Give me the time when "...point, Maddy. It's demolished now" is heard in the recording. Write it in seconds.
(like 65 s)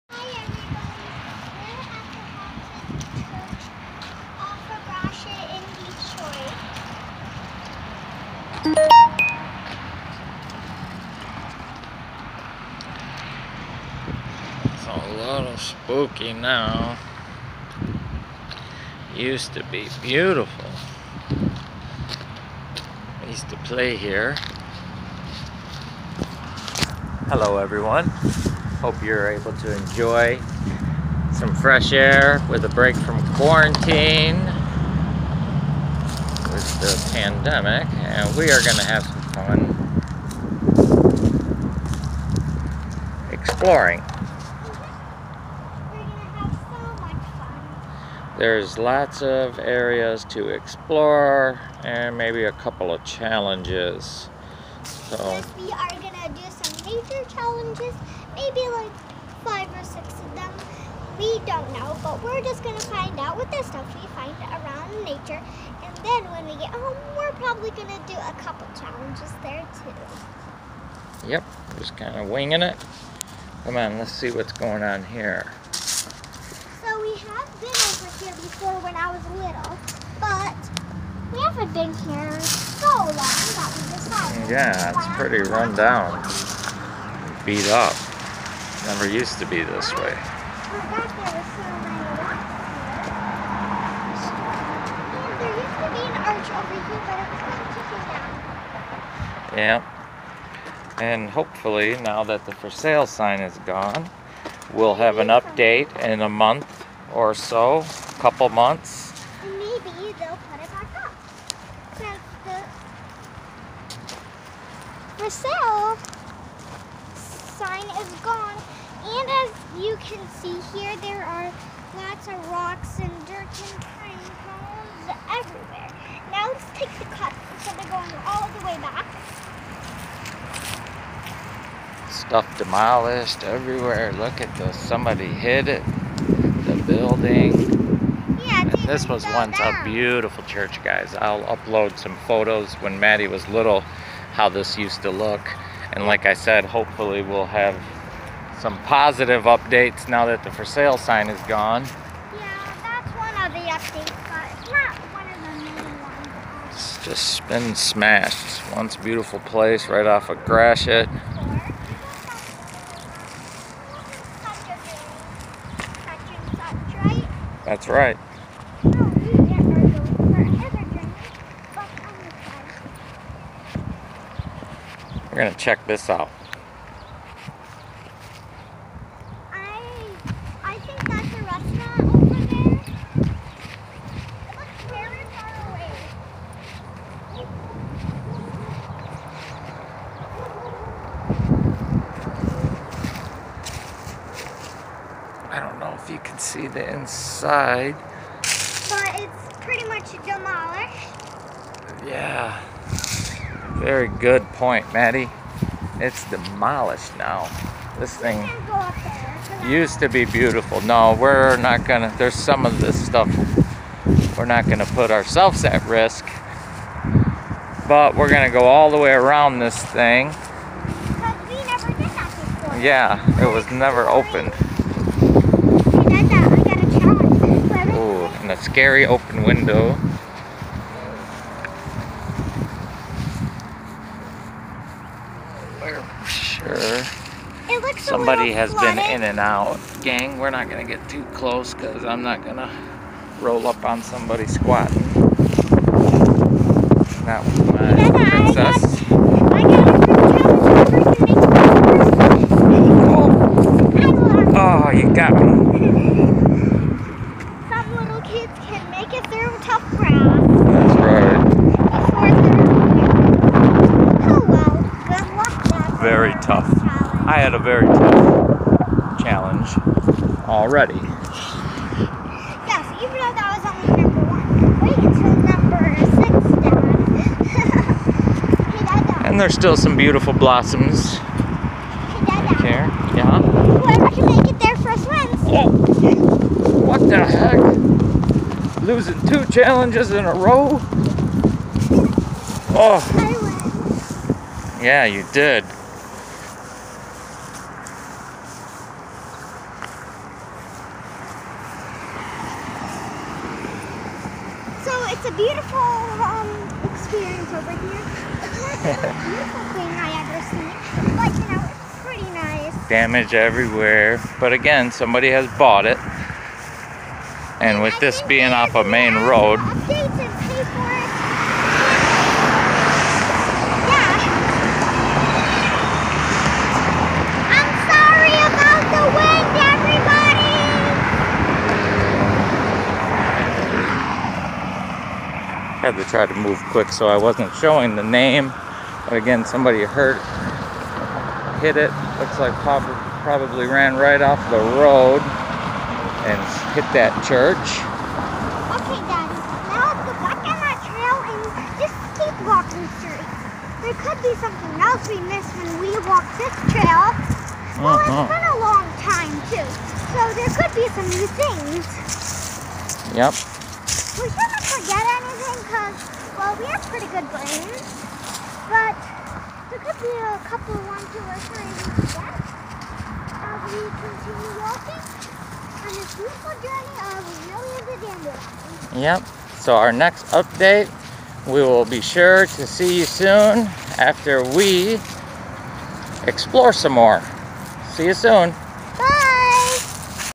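204 s.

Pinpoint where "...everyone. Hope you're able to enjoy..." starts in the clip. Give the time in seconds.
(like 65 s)
27 s.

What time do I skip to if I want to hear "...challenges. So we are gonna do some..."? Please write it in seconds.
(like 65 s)
53 s.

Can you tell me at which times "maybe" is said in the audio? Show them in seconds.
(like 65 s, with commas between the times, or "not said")
52 s, 58 s, 109 s.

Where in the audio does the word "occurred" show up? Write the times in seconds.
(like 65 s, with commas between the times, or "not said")
not said.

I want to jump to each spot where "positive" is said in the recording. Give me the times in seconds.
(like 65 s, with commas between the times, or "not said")
148 s.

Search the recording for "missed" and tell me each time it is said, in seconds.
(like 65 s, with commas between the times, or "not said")
355 s.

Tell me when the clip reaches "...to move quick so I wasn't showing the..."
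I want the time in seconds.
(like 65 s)
336 s.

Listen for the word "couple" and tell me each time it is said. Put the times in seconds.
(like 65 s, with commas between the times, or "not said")
52 s, 68 s, 108 s, 370 s.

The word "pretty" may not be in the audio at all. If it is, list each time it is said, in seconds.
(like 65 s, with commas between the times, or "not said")
85 s, 199 s, 311 s, 366 s.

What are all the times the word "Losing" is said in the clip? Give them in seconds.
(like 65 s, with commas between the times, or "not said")
288 s.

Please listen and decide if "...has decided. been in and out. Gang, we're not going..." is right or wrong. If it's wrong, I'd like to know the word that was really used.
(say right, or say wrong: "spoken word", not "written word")
wrong: "flooded", not "decided".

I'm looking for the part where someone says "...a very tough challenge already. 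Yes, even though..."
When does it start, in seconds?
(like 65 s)
267 s.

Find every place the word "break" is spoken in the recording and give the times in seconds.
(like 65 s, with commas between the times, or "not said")
32 s.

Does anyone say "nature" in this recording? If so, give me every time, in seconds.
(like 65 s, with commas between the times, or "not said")
56 s, 65 s.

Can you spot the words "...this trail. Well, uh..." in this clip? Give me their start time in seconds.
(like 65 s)
356 s.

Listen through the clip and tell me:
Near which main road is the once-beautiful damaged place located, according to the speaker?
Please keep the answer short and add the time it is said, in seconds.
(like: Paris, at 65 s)
Gratiot, at 160 s.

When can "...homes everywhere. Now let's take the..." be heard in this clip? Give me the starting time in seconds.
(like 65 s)
124 s.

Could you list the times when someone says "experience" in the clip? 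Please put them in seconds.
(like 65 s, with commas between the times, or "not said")
306 s.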